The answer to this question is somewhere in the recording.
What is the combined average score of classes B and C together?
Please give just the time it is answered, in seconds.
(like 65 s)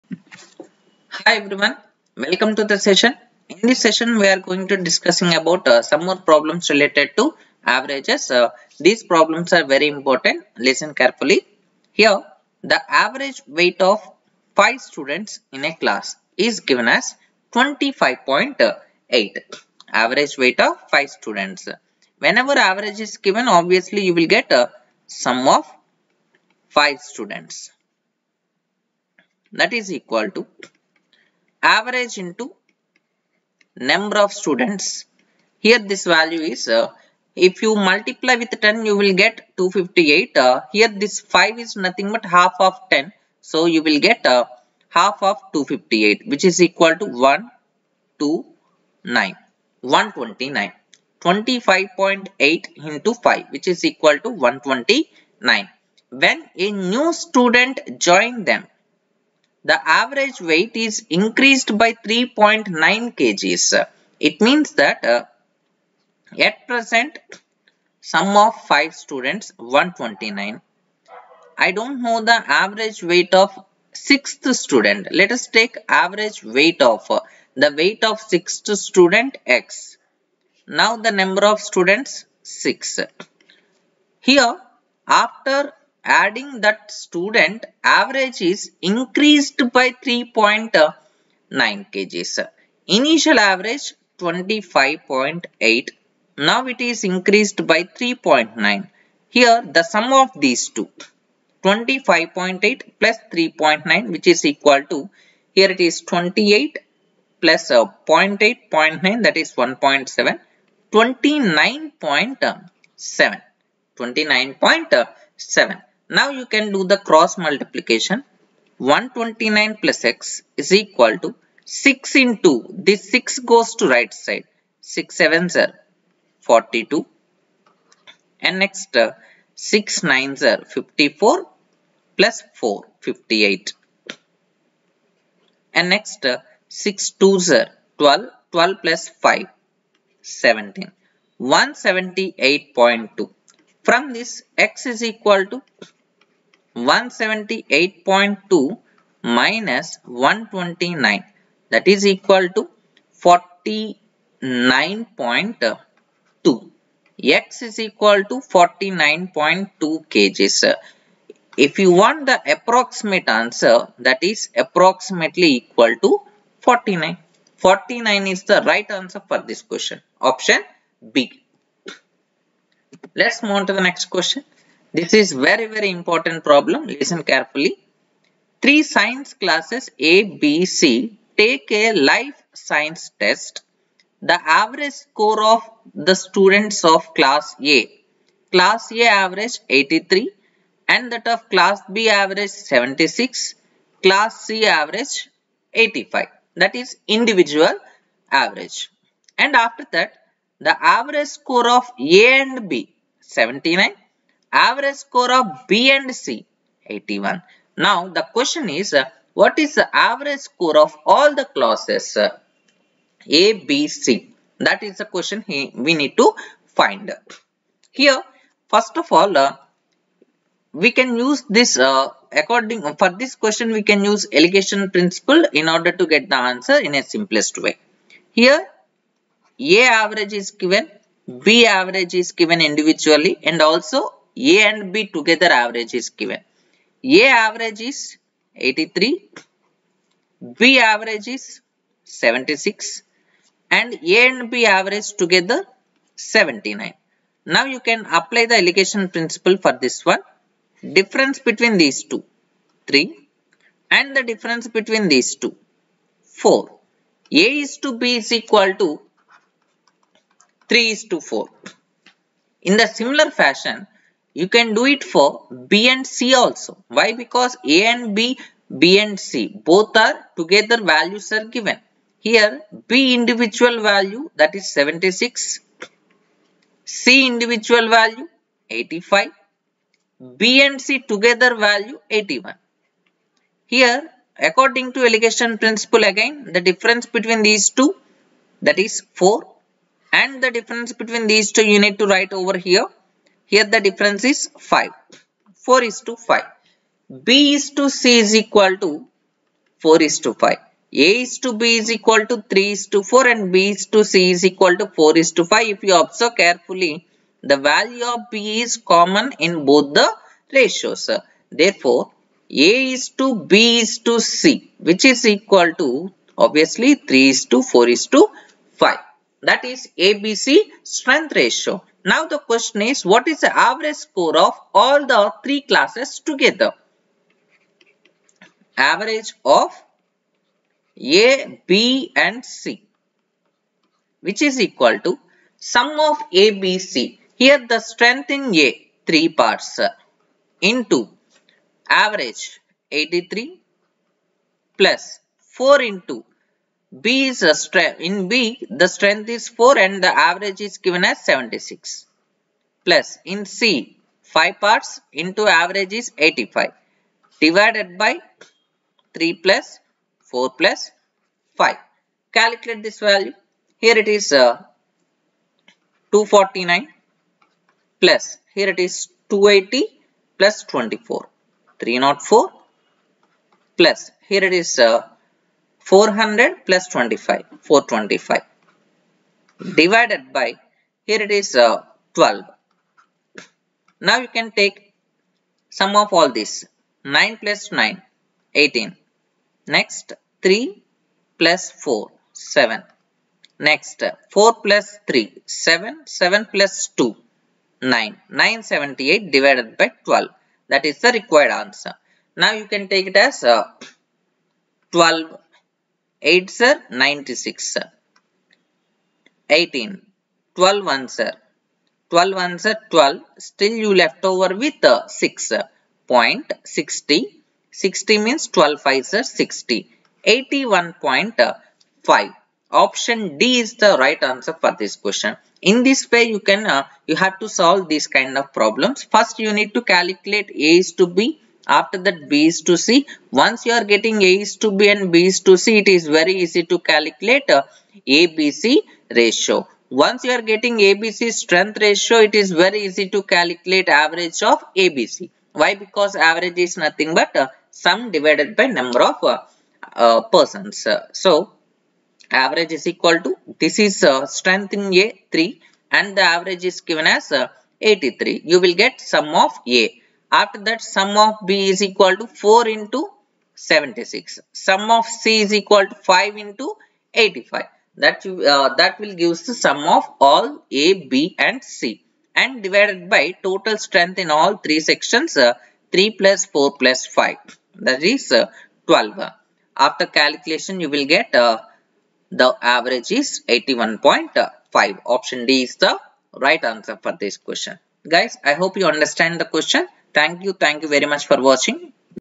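204 s.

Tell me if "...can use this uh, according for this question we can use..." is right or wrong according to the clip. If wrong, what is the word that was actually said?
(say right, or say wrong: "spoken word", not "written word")
right.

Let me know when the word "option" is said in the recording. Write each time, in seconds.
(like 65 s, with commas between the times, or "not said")
170 s, 422 s, 485 s.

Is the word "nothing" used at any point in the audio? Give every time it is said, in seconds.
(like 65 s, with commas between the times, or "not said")
41 s, 446 s.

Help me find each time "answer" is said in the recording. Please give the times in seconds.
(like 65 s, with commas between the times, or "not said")
163 s, 168 s, 226 s, 401 s, 424 s, 486 s.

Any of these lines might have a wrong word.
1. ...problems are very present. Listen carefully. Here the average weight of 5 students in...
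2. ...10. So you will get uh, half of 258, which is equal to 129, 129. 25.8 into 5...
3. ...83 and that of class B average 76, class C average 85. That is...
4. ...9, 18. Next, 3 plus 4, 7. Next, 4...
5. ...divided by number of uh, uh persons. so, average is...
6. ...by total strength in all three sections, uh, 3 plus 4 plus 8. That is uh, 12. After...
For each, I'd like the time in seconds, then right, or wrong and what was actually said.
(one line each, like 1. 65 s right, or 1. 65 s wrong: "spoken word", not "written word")
1. 9 s wrong: "important", not "present"
2. 42 s right
3. 189 s right
4. 387 s right
5. 448 s right
6. 473 s wrong: "5", not "8".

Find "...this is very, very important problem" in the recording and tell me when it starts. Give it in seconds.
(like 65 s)
174 s.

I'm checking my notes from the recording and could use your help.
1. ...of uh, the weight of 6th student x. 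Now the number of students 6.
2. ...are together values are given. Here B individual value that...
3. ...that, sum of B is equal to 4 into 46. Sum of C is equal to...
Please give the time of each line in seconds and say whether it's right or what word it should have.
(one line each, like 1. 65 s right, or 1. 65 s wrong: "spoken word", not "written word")
1. 76 s right
2. 269 s right
3. 460 s wrong: "76", not "46".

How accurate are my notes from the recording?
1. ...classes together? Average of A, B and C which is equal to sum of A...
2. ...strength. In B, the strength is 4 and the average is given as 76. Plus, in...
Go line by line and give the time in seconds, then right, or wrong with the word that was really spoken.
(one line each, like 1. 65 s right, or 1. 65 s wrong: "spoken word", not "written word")
1. 325 s right
2. 347 s right.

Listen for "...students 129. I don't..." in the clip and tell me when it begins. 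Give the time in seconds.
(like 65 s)
68 s.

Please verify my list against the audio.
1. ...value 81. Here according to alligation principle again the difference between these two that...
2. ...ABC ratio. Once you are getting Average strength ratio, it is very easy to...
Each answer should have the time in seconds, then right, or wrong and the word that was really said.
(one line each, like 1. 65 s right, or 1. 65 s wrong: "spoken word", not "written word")
1. 281 s right
2. 438 s wrong: "ABC", not "Average".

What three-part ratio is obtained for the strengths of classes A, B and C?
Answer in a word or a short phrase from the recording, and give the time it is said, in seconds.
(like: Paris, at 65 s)
3:4:5, at 316 s.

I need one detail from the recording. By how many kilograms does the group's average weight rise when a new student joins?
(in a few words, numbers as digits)
3.9.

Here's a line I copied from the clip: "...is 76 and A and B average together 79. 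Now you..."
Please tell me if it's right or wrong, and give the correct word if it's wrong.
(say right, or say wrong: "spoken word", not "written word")
right.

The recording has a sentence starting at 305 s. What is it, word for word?
If you observe carefully, the value of B is common in both the ratios.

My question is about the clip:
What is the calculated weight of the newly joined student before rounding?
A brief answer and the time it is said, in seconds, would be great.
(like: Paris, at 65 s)
49.2 kg, at 158 s.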